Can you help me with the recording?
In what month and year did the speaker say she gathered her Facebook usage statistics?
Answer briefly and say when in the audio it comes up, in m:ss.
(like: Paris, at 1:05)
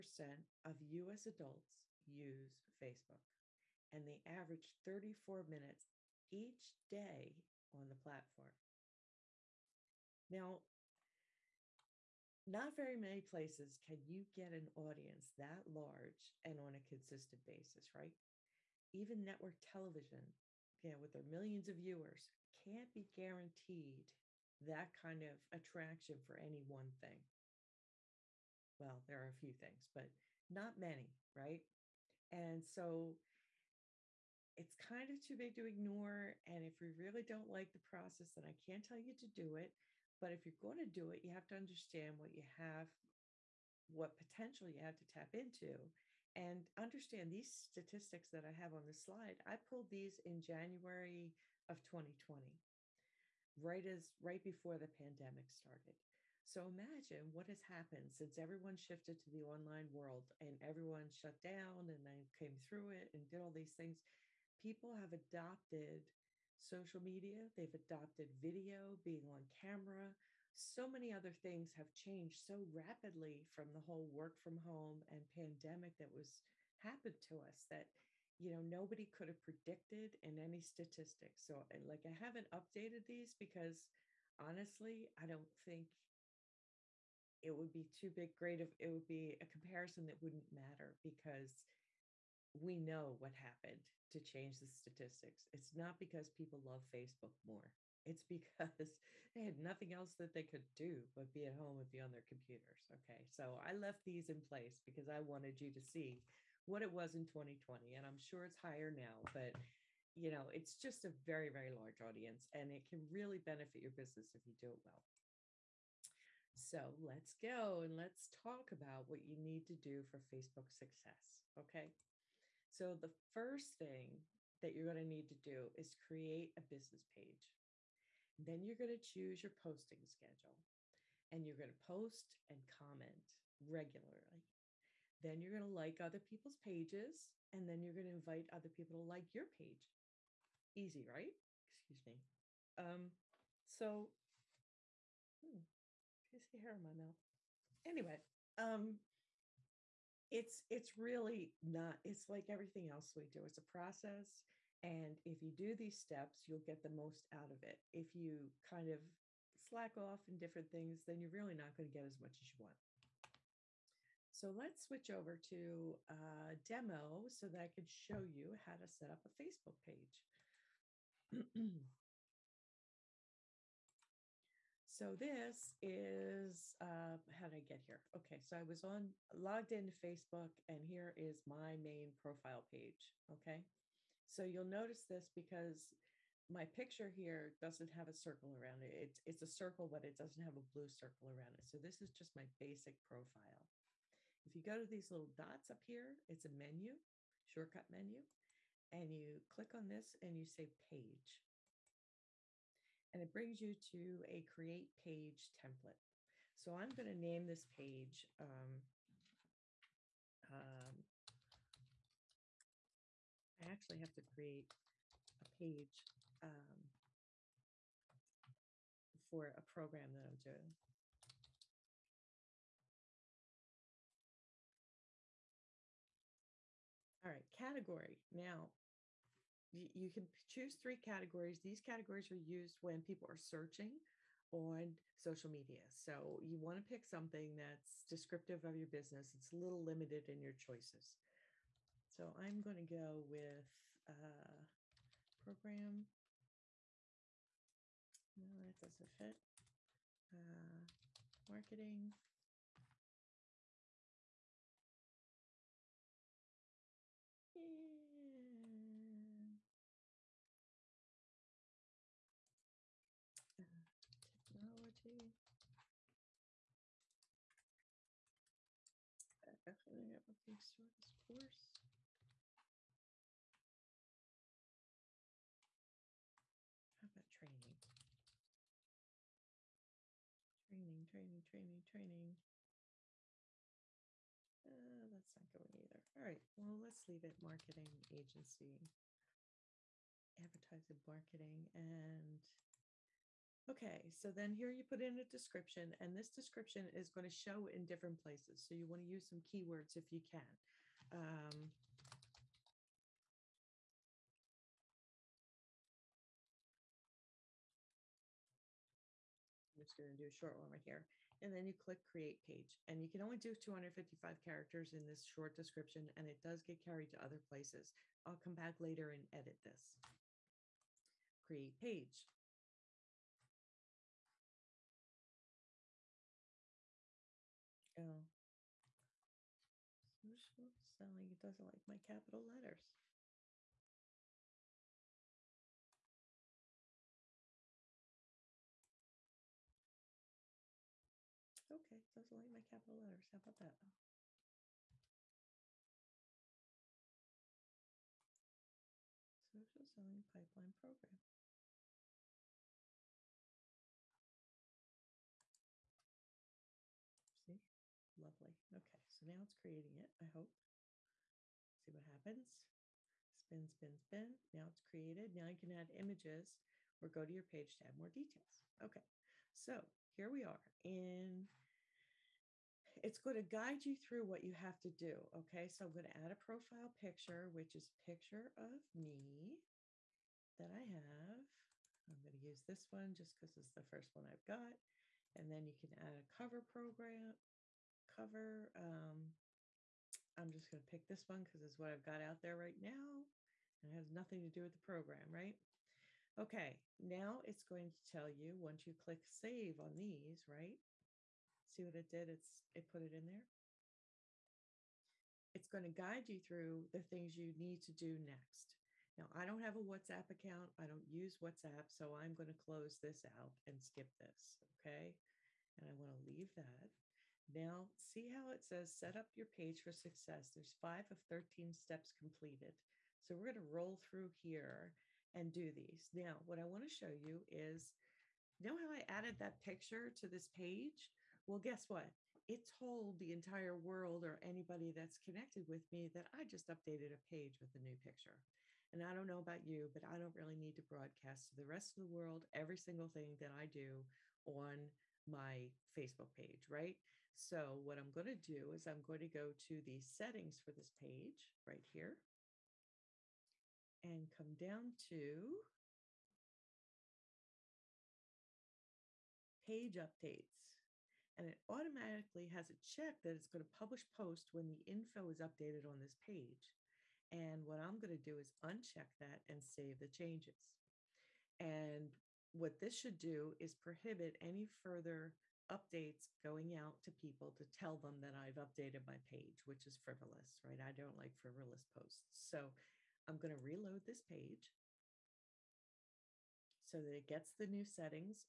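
January 2020, at 0:50.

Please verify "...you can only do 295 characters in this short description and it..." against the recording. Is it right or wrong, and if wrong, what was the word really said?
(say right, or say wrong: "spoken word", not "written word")
wrong: "255", not "295".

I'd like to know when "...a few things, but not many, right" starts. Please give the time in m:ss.
0:29.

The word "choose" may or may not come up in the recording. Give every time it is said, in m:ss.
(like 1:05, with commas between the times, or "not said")
2:08, 3:50.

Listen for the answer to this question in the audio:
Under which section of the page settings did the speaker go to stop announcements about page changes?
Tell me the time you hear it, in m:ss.
7:39.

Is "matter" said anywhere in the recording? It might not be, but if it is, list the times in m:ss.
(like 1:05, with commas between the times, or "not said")
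1:30.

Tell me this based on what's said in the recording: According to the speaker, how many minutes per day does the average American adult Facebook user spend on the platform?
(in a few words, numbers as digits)
34 minutes.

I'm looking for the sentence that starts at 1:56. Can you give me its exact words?
So let's go and let's talk about what you need to do for Facebook success.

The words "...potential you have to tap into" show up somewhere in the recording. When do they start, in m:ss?
0:44.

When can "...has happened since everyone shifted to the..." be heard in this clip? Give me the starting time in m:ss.
0:57.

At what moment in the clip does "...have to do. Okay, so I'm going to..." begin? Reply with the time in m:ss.
6:14.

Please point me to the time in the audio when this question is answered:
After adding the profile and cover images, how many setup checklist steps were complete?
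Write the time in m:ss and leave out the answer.
7:00.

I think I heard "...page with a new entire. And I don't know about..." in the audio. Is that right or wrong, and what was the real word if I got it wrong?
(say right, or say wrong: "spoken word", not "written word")
wrong: "picture", not "entire".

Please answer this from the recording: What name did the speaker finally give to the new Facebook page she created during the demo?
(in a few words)
Social Selling Pipeline Program.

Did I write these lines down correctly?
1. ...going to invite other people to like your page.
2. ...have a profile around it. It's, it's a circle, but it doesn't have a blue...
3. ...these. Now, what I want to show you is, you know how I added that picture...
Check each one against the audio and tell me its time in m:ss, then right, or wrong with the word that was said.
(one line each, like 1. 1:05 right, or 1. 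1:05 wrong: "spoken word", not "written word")
1. 2:17 right
2. 3:07 wrong: "circle", not "profile"
3. 7:05 right.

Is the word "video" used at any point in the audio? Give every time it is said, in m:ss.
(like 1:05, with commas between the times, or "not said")
1:08.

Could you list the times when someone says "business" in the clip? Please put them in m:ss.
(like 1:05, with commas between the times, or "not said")
1:53, 2:06, 3:58.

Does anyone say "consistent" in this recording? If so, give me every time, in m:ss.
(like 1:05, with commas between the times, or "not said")
0:16.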